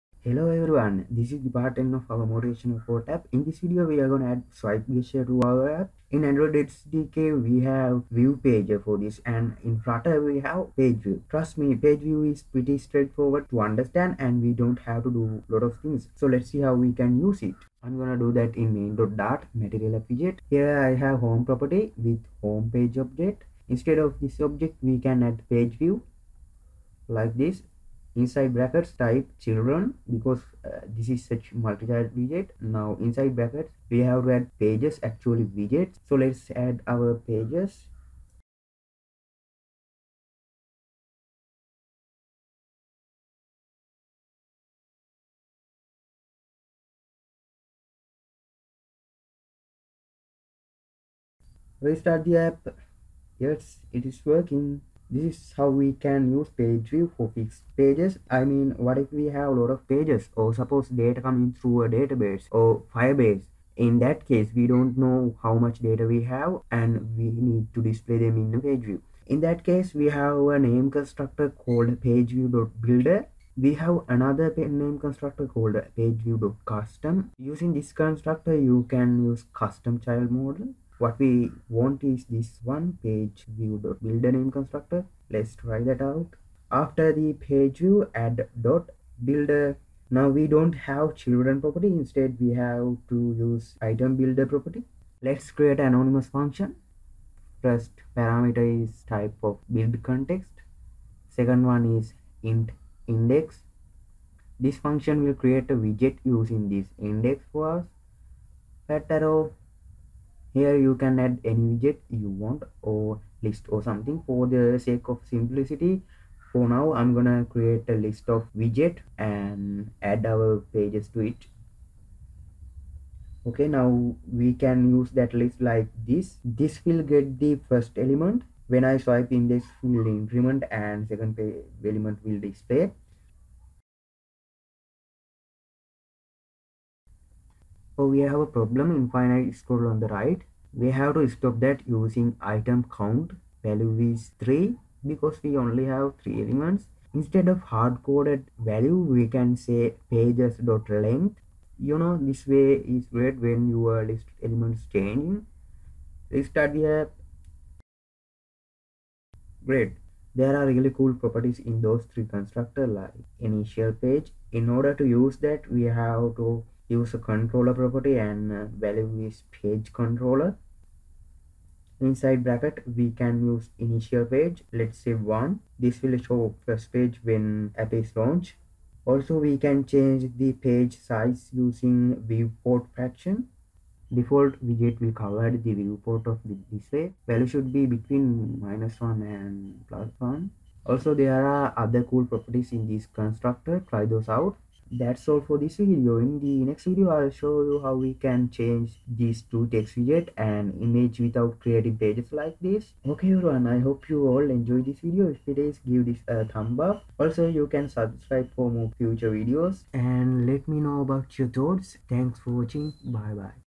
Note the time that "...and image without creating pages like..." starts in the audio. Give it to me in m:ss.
3:20.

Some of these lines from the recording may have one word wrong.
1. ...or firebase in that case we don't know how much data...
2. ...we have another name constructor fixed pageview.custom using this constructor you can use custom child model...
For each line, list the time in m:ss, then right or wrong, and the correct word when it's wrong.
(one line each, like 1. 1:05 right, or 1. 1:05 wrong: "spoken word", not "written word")
1. 1:02 right
2. 1:13 wrong: "called", not "fixed".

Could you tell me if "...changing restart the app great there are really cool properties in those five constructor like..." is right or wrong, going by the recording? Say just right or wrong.
wrong.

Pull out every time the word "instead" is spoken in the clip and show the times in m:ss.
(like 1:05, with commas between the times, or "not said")
0:23, 1:32, 2:27.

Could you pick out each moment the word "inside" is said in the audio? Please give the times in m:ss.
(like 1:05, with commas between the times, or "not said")
0:28, 0:32, 2:52.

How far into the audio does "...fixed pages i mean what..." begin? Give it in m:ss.
0:57.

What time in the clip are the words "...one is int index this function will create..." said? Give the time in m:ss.
1:41.